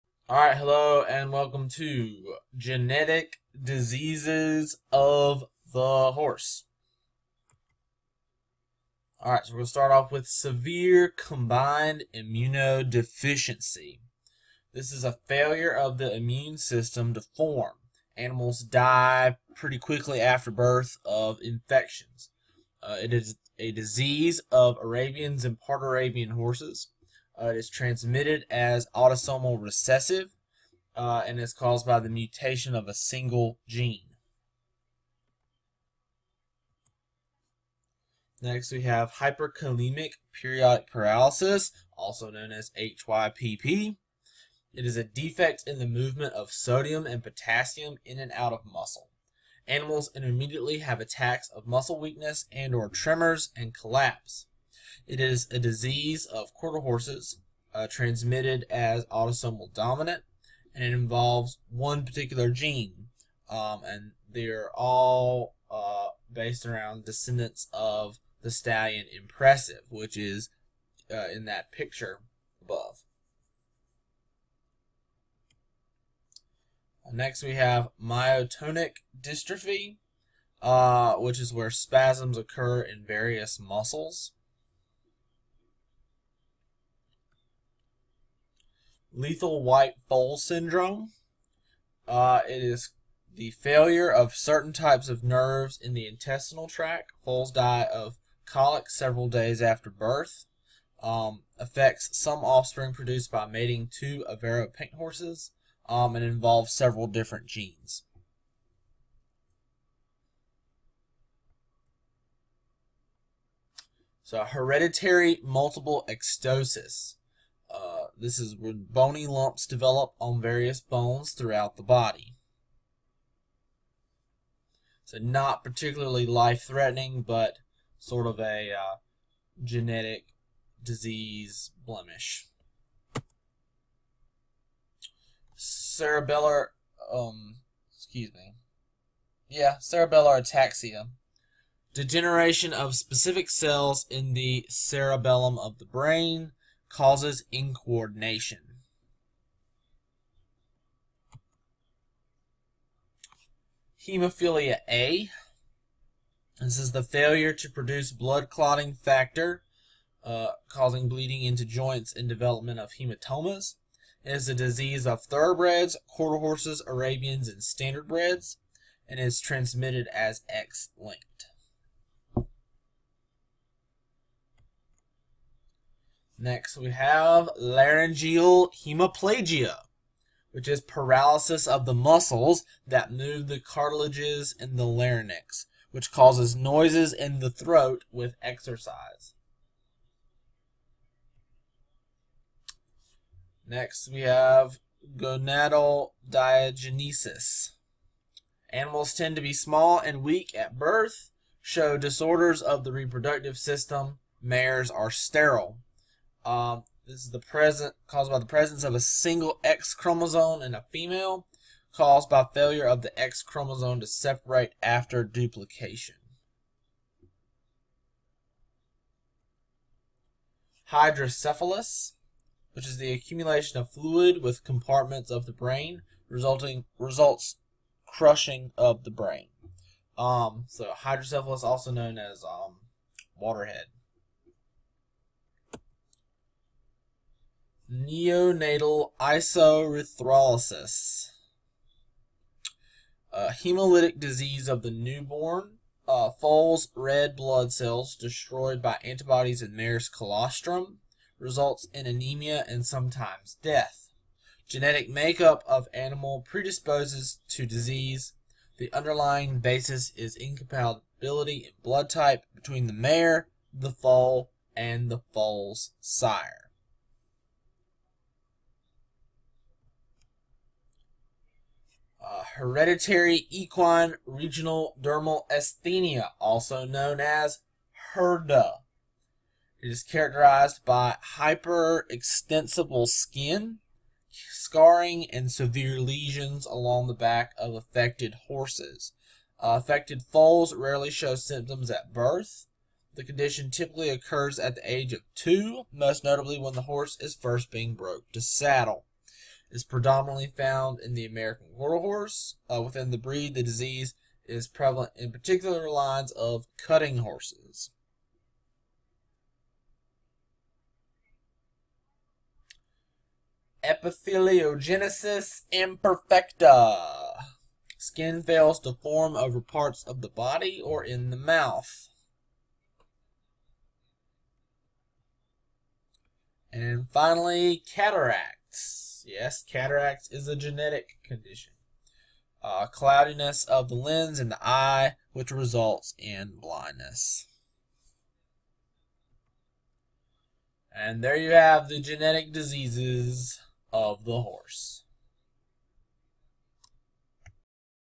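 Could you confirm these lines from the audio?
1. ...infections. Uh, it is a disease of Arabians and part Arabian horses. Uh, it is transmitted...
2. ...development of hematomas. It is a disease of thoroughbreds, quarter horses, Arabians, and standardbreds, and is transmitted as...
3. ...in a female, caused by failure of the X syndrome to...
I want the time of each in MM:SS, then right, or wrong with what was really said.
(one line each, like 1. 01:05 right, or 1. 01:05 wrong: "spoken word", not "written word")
1. 00:21 right
2. 02:42 right
3. 03:30 wrong: "chromosome", not "syndrome".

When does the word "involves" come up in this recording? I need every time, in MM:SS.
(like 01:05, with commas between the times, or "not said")
01:00, 01:46.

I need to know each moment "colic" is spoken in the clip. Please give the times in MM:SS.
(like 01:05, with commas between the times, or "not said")
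01:38.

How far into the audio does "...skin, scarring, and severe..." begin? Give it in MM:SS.
04:43.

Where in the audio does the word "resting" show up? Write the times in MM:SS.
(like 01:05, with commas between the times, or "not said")
not said.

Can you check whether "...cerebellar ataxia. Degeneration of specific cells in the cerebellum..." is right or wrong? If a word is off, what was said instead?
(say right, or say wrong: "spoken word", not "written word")
right.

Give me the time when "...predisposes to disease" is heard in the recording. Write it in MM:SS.
04:16.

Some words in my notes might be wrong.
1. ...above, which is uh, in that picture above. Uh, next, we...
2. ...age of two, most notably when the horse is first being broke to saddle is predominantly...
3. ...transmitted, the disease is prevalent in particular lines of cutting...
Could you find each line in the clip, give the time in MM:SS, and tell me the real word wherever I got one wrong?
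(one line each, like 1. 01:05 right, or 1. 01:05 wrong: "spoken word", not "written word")
1. 01:09 wrong: "impressive", not "above"
2. 04:54 right
3. 05:03 wrong: "breed", not "transmitted".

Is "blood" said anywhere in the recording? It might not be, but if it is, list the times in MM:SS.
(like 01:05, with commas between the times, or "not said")
02:38, 04:07, 04:21.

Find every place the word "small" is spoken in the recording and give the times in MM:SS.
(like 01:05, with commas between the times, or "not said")
03:19.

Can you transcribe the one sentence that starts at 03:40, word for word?
Hydrocephalus, which is the accumulation of fluid with compartments of the brain, resulting results crushing of the brain.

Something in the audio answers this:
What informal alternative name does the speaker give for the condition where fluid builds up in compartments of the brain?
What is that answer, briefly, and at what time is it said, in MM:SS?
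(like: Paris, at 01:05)
waterhead, at 03:53.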